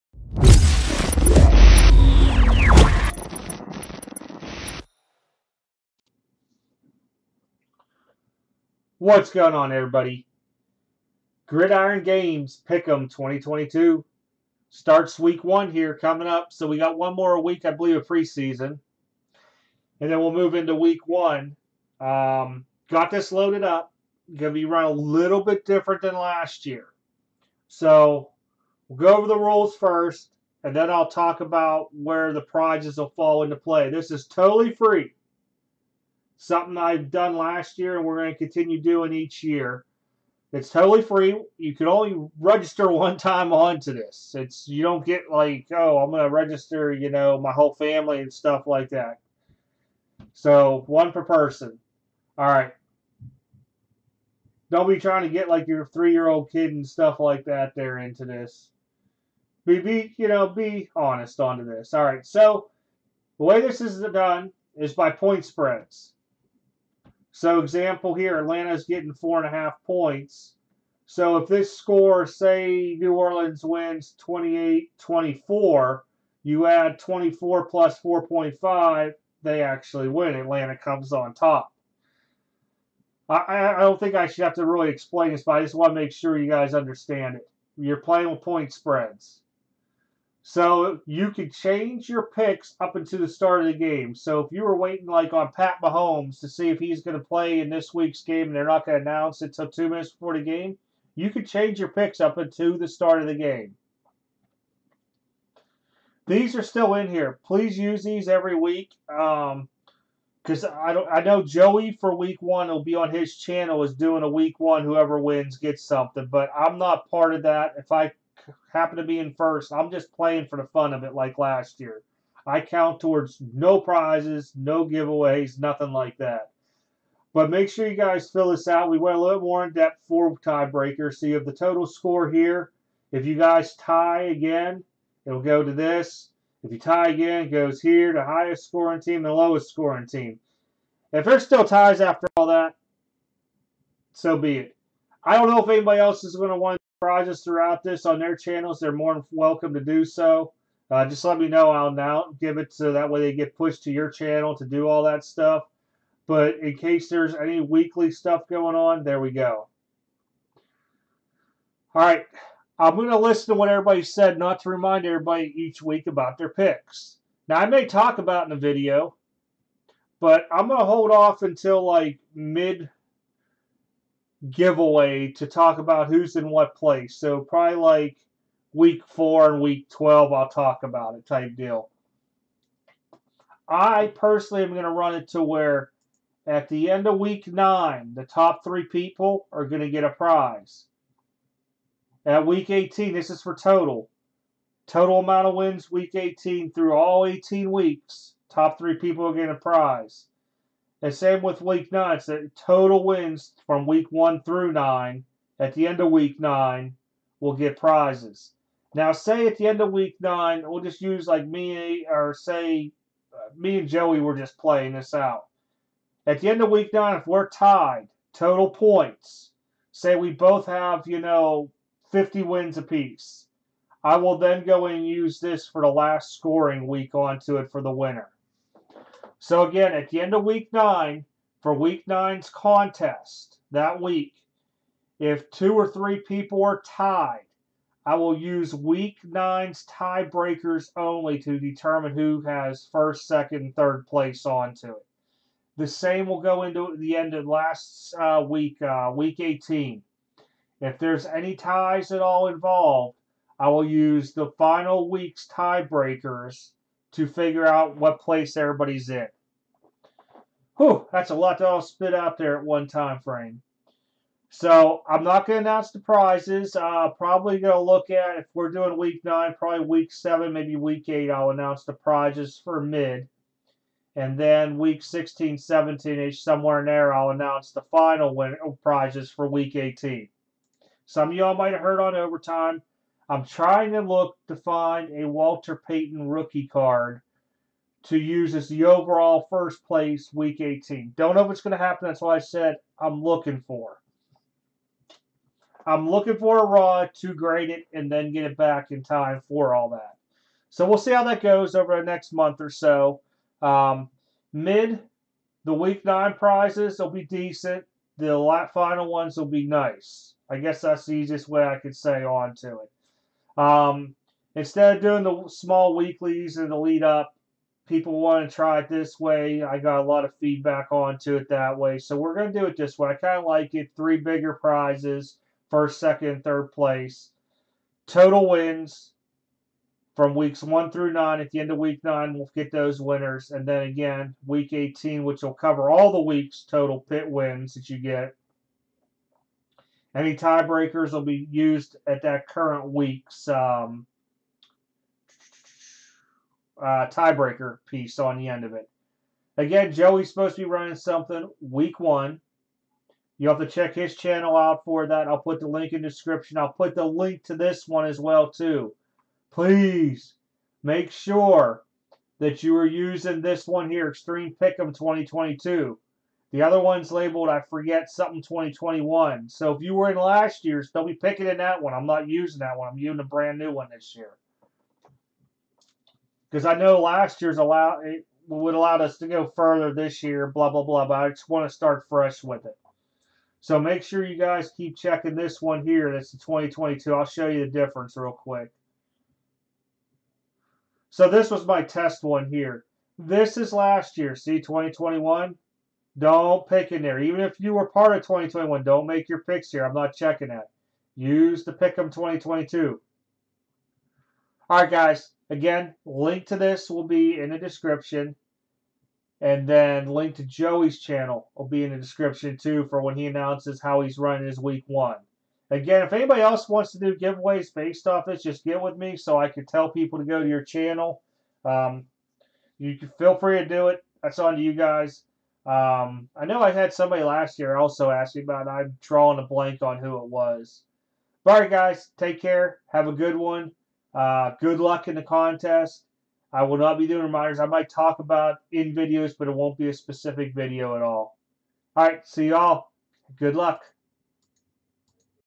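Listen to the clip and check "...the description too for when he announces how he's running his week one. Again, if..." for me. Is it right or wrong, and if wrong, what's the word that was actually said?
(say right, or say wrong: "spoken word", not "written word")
right.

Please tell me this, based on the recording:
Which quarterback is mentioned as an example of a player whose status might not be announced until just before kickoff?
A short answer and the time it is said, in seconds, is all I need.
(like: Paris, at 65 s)
Pat Mahomes, at 95 s.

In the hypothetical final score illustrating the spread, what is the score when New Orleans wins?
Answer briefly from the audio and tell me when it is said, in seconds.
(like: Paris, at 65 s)
28-24, at 74 s.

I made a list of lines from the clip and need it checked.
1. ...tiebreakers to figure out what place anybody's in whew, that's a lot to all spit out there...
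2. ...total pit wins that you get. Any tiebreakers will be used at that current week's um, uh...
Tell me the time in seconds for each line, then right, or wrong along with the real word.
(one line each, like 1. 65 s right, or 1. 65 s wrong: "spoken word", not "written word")
1. 255 s wrong: "everybody", not "anybody"
2. 336 s right.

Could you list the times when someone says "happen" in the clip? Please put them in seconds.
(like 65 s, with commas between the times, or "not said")
118 s, 291 s.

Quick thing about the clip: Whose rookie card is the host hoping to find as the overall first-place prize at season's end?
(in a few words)
Walter Payton.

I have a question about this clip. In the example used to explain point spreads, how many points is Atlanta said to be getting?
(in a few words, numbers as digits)
4.5.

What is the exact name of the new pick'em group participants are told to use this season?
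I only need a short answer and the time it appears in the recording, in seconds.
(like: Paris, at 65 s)
Extreme Pick'em 2022, at 364 s.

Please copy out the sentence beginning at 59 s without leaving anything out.
Be, be, you know, be honest onto this.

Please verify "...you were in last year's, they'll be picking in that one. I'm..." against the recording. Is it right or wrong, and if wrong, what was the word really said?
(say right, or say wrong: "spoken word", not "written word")
right.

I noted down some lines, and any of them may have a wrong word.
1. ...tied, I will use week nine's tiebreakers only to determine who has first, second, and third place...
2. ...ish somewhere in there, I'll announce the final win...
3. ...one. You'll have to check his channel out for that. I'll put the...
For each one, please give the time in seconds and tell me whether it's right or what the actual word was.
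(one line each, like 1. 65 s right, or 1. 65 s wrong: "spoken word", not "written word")
1. 236 s right
2. 276 s right
3. 351 s right.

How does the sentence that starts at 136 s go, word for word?
If you tie again, it goes here, the highest scoring team and lowest scoring team.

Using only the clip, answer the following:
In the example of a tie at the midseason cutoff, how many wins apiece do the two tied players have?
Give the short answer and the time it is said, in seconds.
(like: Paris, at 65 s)
50, at 222 s.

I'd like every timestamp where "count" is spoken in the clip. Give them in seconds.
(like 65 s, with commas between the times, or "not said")
122 s.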